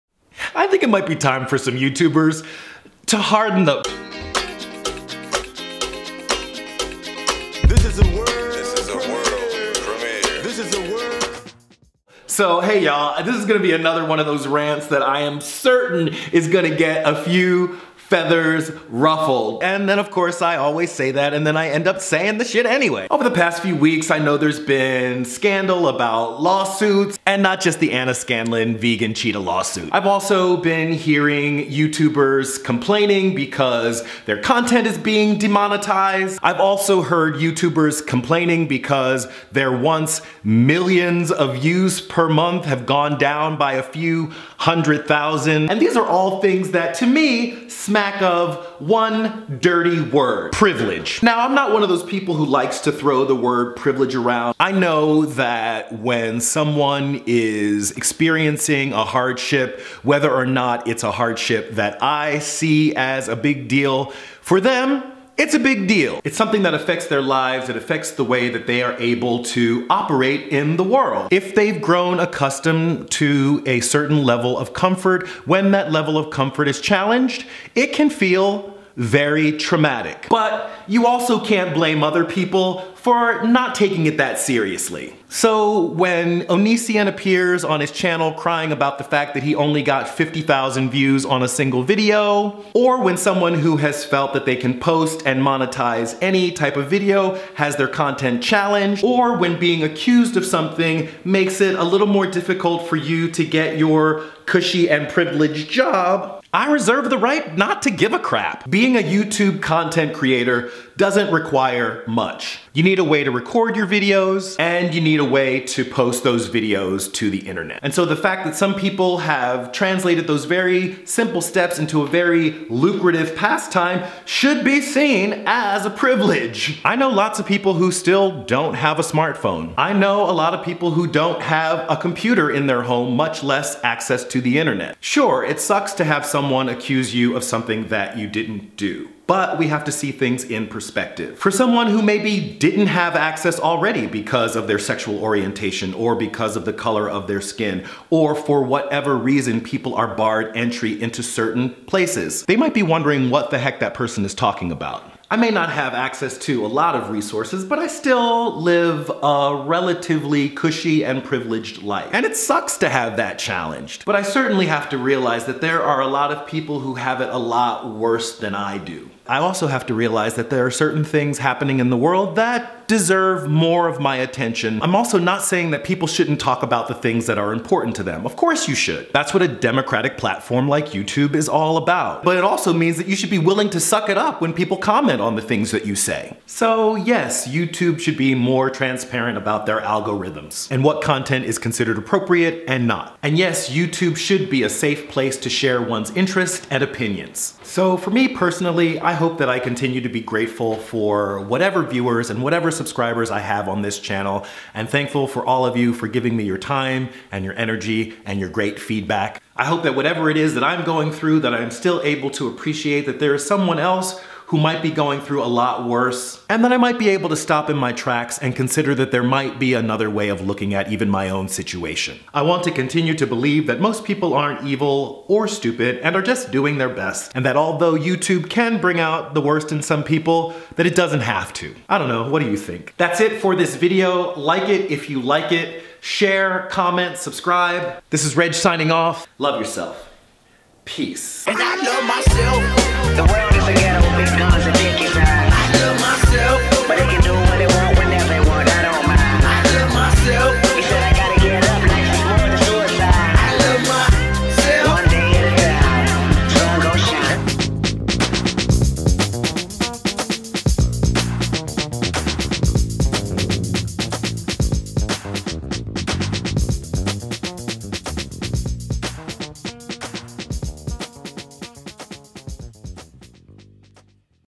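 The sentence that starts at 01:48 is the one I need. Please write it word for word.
Being a YouTube content creator doesn't require much.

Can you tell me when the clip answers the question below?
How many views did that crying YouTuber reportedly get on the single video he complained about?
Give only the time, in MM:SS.
01:30.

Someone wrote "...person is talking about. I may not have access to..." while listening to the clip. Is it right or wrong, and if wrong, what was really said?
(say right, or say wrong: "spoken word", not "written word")
right.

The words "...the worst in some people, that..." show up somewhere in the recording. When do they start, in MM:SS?
03:49.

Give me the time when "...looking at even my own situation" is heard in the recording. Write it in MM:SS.
03:40.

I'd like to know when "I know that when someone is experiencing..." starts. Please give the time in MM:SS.
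00:54.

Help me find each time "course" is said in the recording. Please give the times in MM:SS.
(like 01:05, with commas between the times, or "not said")
00:20, 02:58.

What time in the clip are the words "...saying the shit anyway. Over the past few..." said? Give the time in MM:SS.
00:22.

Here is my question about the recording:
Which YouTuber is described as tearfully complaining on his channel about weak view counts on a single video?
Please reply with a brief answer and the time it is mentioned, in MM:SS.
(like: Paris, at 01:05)
Onision, at 01:26.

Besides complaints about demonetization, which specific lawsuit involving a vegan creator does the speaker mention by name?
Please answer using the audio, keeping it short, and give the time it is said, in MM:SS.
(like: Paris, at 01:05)
Anna Scanlon vegan cheetah lawsuit, at 00:27.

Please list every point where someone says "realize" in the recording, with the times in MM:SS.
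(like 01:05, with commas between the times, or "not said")
02:44, 02:49.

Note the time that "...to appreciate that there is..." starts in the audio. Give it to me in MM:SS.
03:32.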